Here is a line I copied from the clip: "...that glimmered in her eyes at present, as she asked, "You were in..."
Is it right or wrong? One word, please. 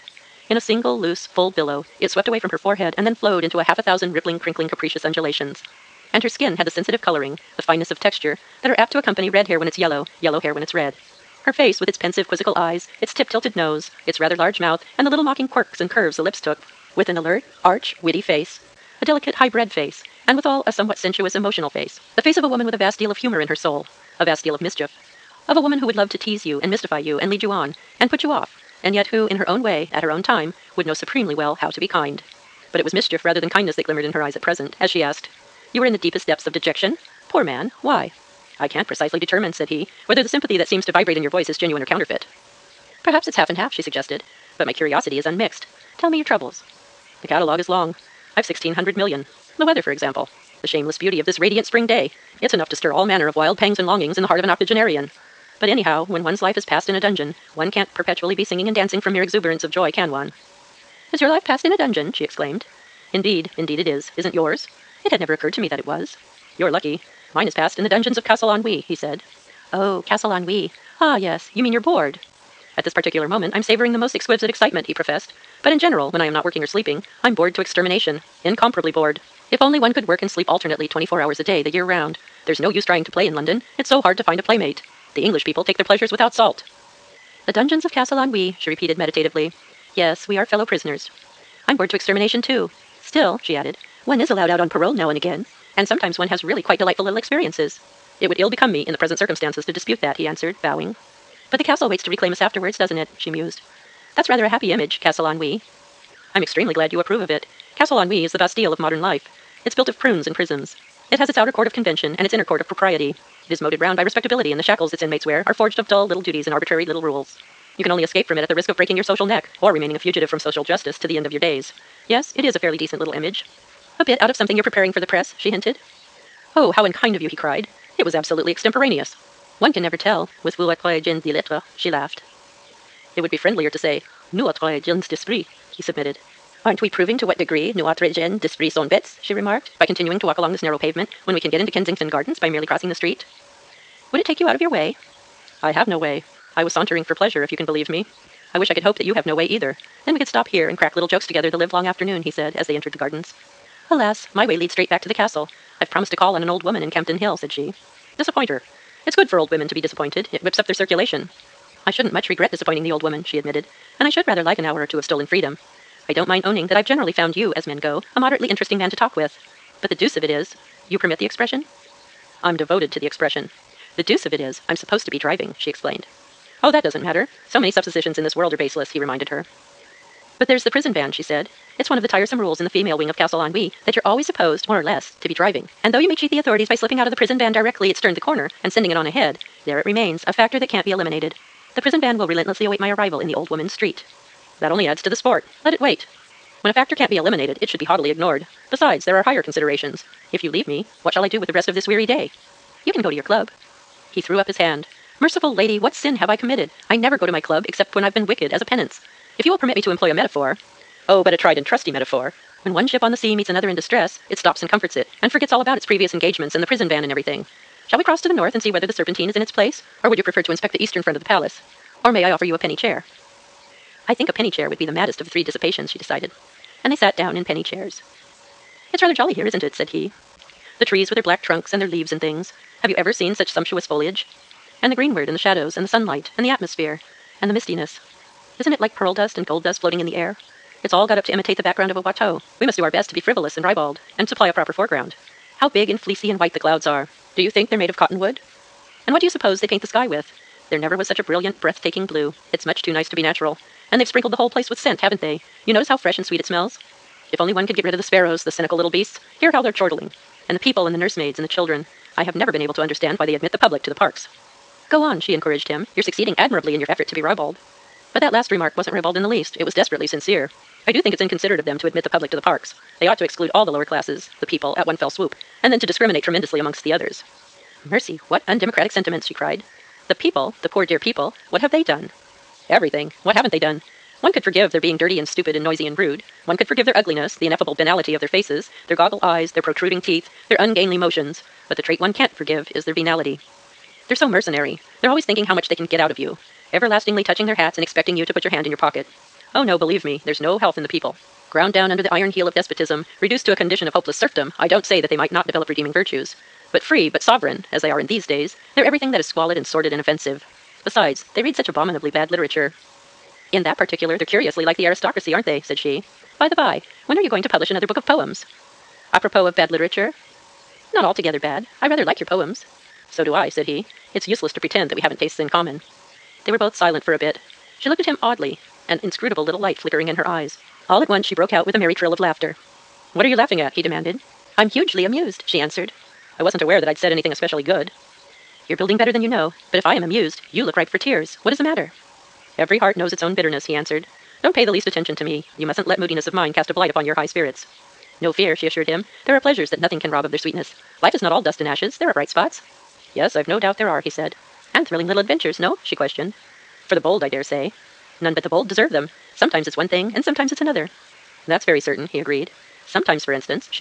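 right.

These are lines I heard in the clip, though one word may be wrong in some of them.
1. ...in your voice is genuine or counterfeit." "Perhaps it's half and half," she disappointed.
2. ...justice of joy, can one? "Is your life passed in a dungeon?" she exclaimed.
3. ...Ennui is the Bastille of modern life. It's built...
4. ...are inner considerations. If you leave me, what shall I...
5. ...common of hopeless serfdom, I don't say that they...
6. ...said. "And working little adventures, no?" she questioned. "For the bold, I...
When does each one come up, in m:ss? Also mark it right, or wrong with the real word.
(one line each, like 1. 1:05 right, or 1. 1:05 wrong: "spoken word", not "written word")
1. 0:41 wrong: "suggested", not "disappointed"
2. 0:59 wrong: "exuberance", not "justice"
3. 1:47 right
4. 3:19 wrong: "higher", not "inner"
5. 5:03 wrong: "condition", not "common"
6. 5:54 wrong: "thrilling", not "working".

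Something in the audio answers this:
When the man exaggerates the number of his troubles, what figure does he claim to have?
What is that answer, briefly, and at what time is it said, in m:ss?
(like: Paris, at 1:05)
1600000000, at 0:48.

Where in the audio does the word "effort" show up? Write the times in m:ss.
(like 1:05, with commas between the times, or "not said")
4:26.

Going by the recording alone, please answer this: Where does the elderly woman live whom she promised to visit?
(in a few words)
Campden Hill.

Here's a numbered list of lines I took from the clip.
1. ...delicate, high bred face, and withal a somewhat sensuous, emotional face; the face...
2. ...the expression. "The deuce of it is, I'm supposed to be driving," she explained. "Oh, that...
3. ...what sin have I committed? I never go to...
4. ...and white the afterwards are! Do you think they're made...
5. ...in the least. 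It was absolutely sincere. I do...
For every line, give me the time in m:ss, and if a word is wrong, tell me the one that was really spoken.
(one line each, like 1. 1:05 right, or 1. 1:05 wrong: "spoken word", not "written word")
1. 0:19 right
2. 2:52 right
3. 3:25 right
4. 4:06 wrong: "clouds", not "afterwards"
5. 4:29 wrong: "desperately", not "absolutely".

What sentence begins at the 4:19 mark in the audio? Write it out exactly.
Hear how they're chortling and the people and the nursemaids and the children.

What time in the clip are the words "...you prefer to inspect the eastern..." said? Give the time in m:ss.
3:40.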